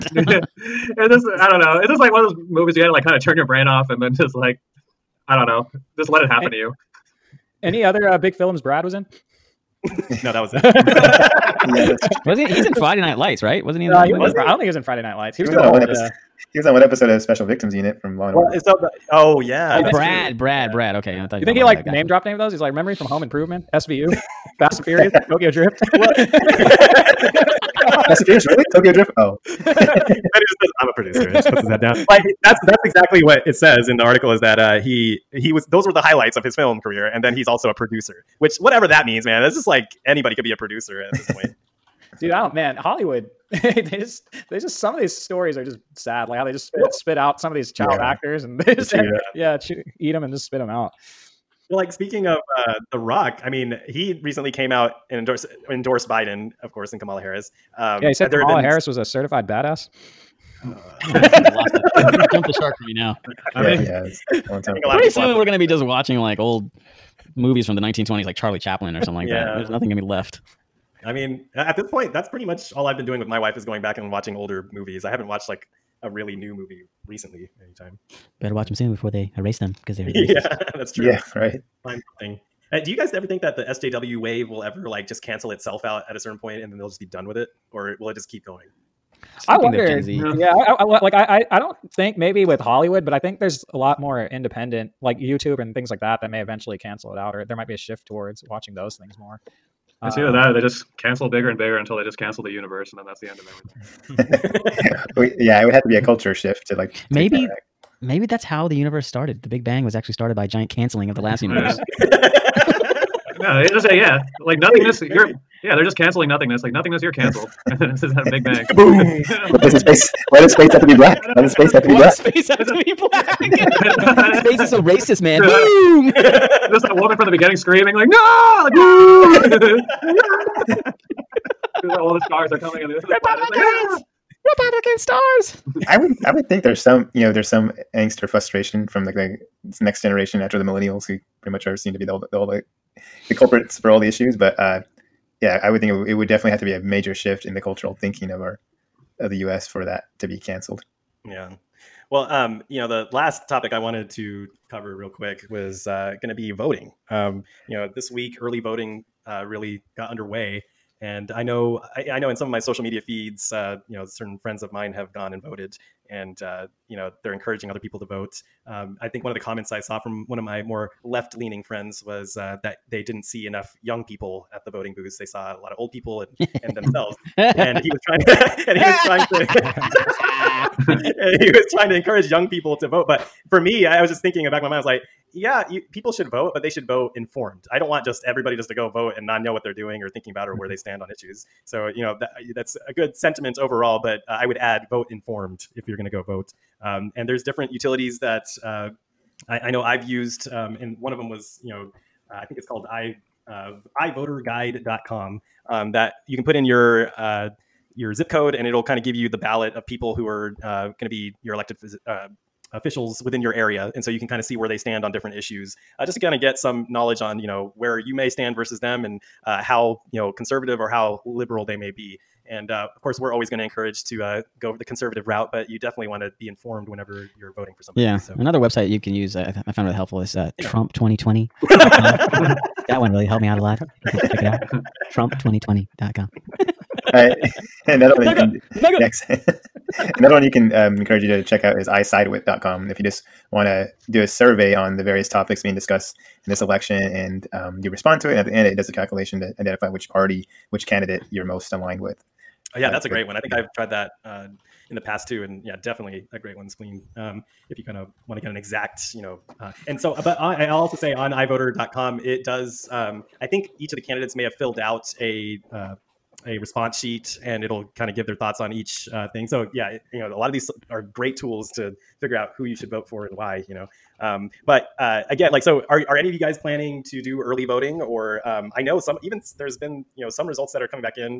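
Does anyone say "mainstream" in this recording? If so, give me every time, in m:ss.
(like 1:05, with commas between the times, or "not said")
not said.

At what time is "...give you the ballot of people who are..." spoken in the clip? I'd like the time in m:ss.
3:29.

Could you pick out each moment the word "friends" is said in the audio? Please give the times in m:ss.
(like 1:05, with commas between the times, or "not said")
2:44, 2:51.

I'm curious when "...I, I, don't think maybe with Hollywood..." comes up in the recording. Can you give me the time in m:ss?
1:31.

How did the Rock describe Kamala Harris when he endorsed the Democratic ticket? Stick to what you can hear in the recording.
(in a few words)
A certified badass.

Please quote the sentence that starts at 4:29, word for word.
So, yeah, it, you know, a lot of these are great tools to figure out who you should vote for and why.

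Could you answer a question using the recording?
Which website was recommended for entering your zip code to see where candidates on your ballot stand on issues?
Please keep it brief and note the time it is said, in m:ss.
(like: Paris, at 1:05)
iVoterGuide.com, at 3:23.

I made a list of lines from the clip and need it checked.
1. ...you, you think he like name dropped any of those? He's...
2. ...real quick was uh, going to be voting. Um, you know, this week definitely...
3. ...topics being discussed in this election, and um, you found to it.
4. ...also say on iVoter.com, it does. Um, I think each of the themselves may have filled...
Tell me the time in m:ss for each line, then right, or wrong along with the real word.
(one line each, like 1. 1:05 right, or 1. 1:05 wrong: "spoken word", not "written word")
1. 0:21 right
2. 2:34 wrong: "early", not "definitely"
3. 4:05 wrong: "respond", not "found"
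4. 4:20 wrong: "candidates", not "themselves".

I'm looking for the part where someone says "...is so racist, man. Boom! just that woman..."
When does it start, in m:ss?
2:04.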